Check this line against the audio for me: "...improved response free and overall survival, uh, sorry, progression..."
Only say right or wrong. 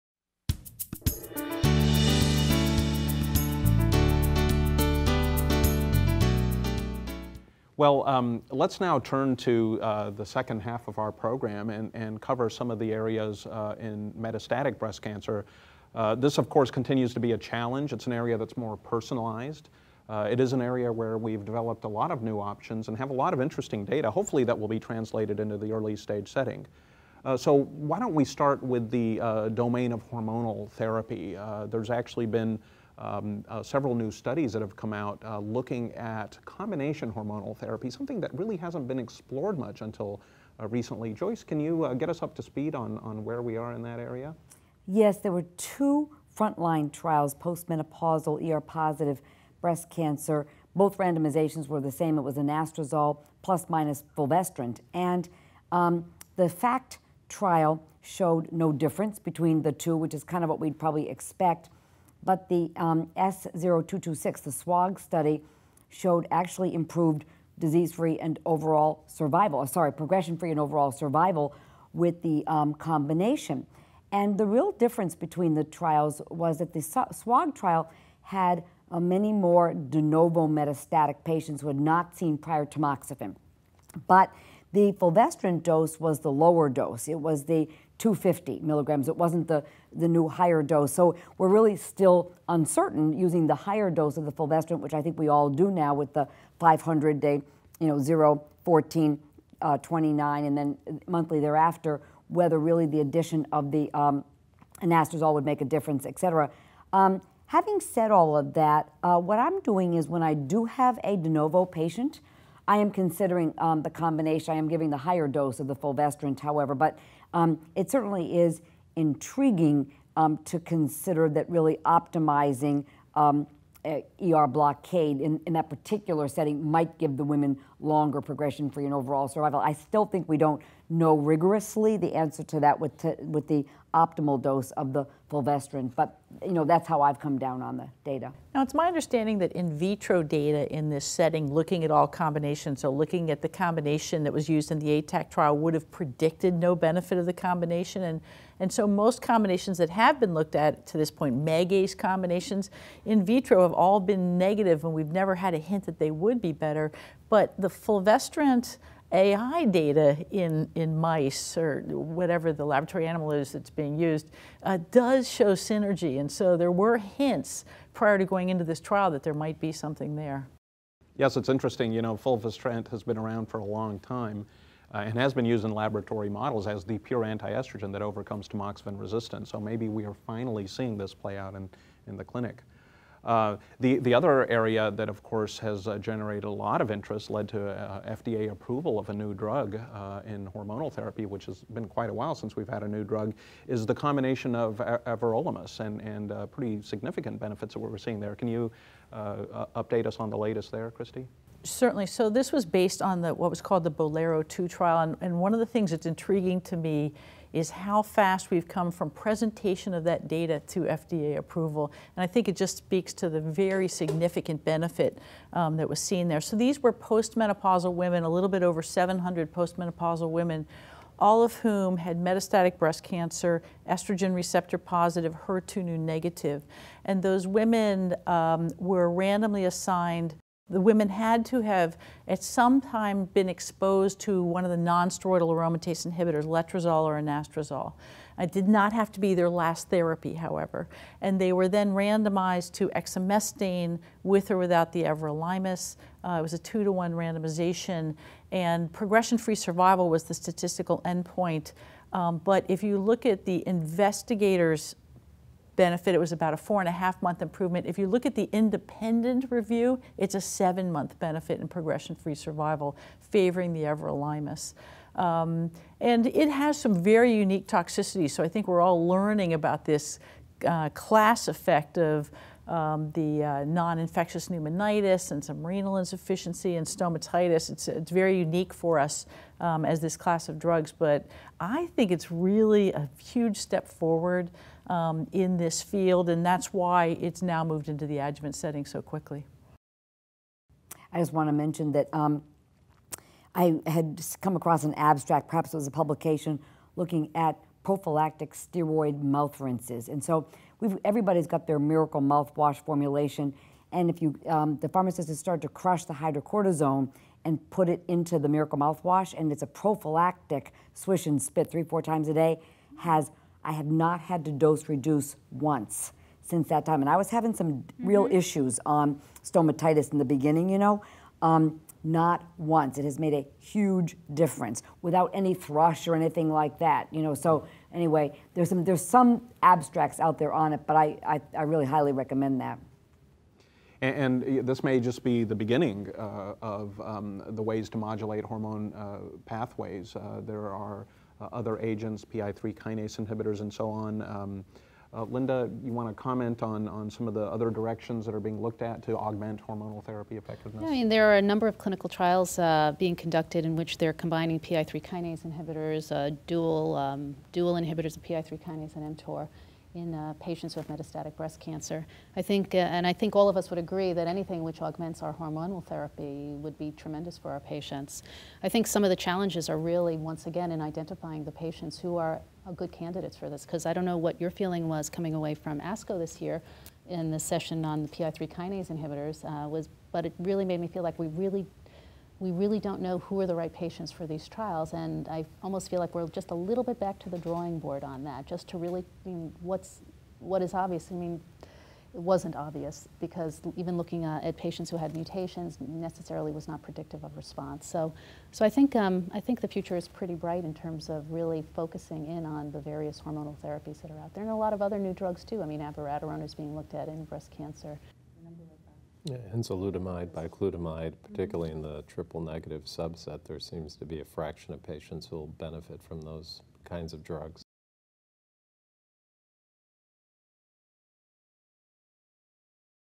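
wrong.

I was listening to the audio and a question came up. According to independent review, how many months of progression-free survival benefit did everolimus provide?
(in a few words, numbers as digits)
7 months.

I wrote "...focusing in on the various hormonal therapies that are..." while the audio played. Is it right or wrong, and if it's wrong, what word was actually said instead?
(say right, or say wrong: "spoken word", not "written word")
right.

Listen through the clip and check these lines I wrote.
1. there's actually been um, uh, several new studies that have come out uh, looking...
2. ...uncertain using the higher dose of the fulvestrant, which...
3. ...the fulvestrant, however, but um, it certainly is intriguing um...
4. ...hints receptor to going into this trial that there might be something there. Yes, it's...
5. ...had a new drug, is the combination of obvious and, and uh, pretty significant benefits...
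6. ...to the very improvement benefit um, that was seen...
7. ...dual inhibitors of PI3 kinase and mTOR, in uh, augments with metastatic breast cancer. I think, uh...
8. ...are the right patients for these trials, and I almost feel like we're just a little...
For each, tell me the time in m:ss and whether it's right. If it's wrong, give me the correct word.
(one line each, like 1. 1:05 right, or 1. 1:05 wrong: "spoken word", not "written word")
1. 0:31 right
2. 1:32 right
3. 1:55 right
4. 2:46 wrong: "prior", not "receptor"
5. 3:12 wrong: "everolimus", not "obvious"
6. 3:33 wrong: "significant", not "improvement"
7. 5:57 wrong: "patients", not "augments"
8. 6:23 right.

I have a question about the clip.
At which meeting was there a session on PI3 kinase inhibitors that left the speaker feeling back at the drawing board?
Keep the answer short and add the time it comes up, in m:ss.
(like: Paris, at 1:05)
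ASCO, at 6:15.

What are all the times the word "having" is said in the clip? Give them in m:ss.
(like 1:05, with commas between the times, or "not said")
1:47, 5:17.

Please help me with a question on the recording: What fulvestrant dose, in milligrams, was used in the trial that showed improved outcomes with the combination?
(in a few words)
250.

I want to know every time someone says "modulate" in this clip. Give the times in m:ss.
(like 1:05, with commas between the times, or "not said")
5:37.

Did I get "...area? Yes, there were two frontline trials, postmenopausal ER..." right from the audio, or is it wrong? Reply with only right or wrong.
right.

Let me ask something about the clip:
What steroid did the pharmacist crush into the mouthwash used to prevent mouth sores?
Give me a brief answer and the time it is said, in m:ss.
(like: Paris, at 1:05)
hydrocortisone, at 5:06.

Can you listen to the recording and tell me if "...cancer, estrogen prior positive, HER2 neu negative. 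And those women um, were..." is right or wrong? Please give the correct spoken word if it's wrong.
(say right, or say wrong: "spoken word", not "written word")
wrong: "receptor", not "prior".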